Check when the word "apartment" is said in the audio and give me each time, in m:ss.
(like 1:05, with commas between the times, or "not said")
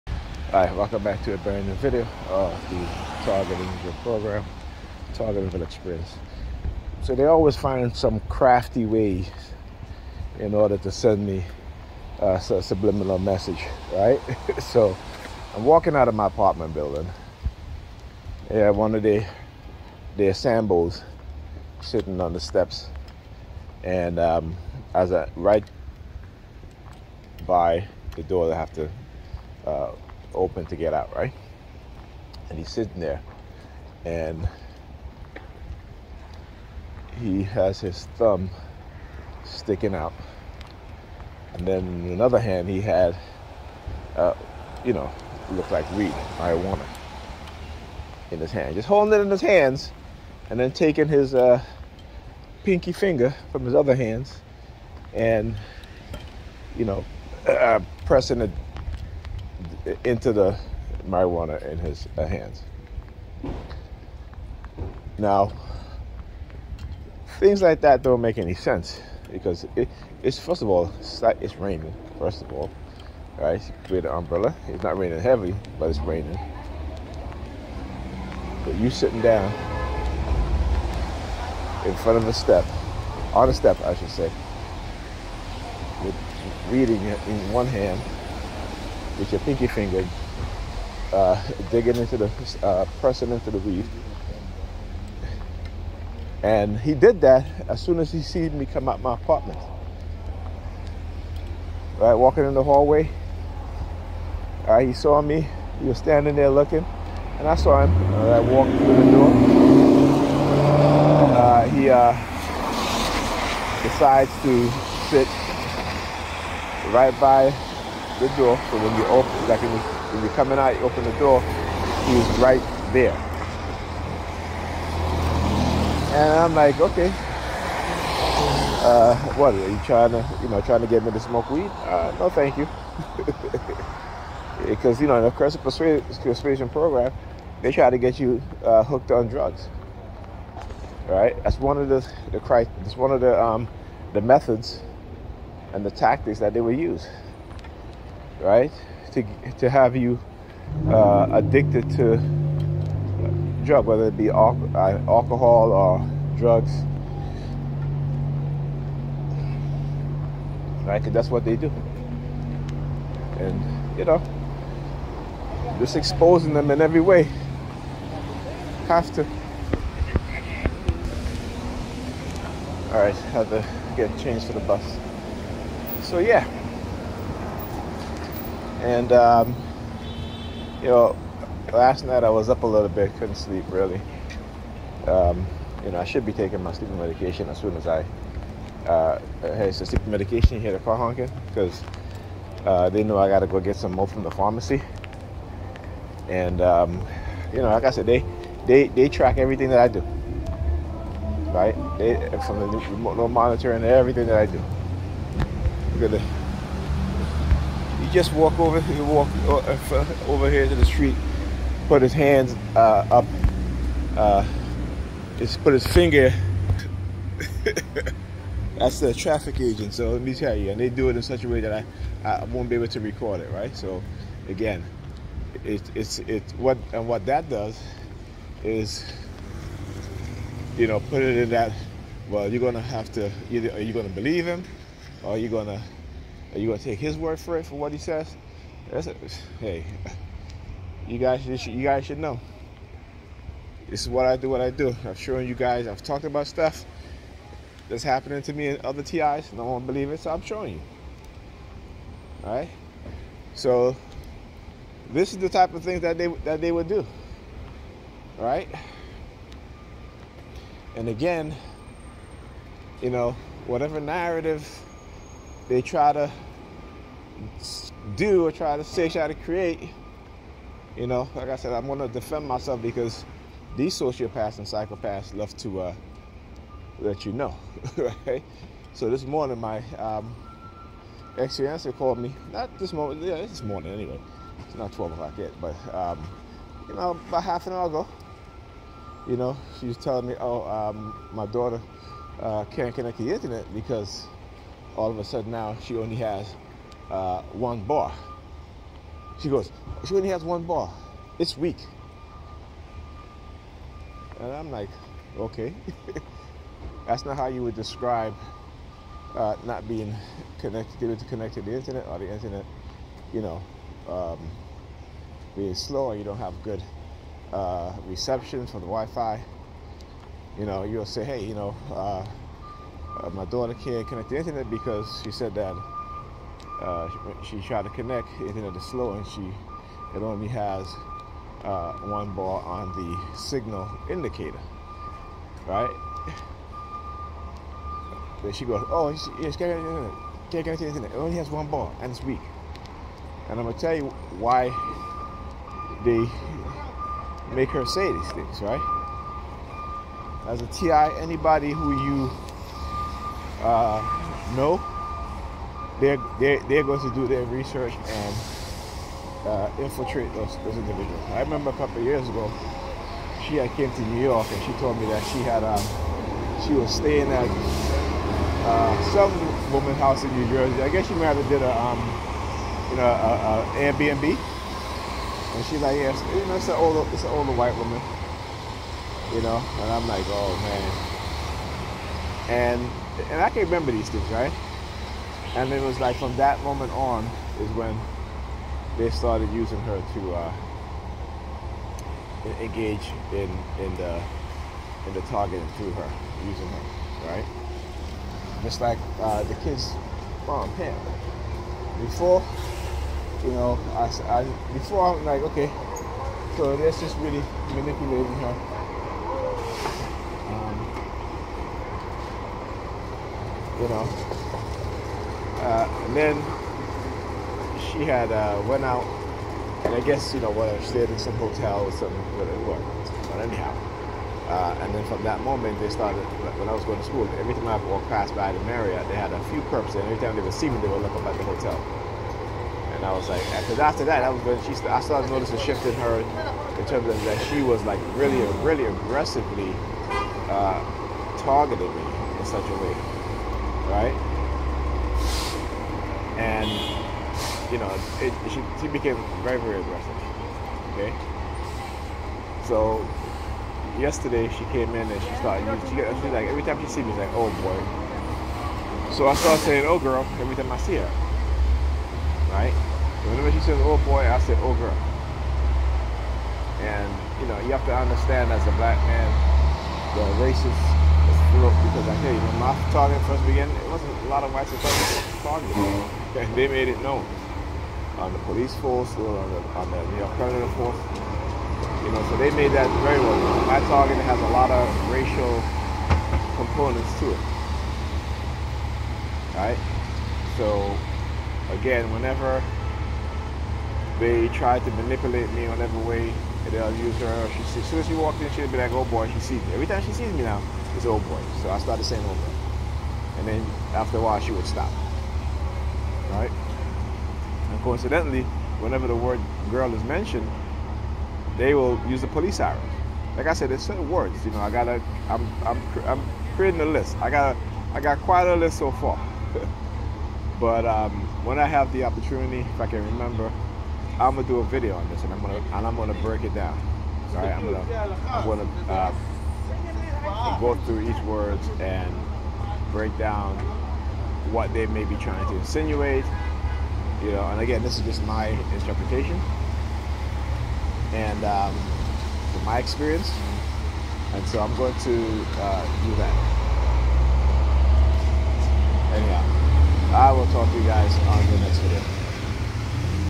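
0:16, 1:39.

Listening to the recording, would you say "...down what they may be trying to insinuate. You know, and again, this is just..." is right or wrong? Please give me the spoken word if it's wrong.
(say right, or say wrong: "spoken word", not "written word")
right.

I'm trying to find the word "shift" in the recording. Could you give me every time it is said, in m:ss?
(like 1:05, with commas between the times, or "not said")
7:15.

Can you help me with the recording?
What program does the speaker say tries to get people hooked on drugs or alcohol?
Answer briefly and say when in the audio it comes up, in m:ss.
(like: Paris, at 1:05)
coercive persuasion program, at 2:15.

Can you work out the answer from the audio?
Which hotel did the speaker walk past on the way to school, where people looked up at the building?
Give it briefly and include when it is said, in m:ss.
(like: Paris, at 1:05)
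Marriott, at 7:08.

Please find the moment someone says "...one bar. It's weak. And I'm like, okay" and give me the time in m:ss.
5:00.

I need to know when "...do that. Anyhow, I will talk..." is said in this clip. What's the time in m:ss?
9:06.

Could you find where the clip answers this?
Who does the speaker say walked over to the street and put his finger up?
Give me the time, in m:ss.
3:39.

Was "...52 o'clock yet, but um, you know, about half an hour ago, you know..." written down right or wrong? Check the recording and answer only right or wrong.
wrong.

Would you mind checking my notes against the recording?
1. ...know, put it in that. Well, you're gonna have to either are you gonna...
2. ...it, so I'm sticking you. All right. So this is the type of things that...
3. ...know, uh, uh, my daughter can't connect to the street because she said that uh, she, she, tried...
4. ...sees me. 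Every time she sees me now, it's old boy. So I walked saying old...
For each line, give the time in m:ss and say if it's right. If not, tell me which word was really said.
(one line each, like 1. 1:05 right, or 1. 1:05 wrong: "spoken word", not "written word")
1. 3:50 right
2. 4:10 wrong: "showing", not "sticking"
3. 5:21 wrong: "internet", not "street"
4. 8:19 wrong: "started", not "walked".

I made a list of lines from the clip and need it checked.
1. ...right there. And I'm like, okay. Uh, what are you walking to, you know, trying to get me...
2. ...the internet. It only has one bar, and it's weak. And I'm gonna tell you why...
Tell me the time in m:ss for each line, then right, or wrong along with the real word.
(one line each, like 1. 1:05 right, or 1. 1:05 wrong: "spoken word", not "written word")
1. 2:02 wrong: "trying", not "walking"
2. 5:40 right.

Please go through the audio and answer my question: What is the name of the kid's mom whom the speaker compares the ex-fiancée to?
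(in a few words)
Pam.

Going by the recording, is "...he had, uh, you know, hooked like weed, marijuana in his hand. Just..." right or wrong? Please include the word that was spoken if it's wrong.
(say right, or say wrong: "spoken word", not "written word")
wrong: "looked", not "hooked".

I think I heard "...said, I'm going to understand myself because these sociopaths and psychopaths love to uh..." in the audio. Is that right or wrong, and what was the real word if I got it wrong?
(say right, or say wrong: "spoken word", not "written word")
wrong: "defend", not "understand".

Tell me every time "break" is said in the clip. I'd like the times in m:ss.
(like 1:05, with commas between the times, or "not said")
8:46, 8:52.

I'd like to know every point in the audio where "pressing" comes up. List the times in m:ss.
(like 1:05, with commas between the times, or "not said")
0:58, 1:32.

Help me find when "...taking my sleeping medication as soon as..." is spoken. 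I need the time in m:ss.
3:06.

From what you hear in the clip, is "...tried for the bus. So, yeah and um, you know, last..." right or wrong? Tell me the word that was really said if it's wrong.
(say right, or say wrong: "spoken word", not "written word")
wrong: "changed", not "tried".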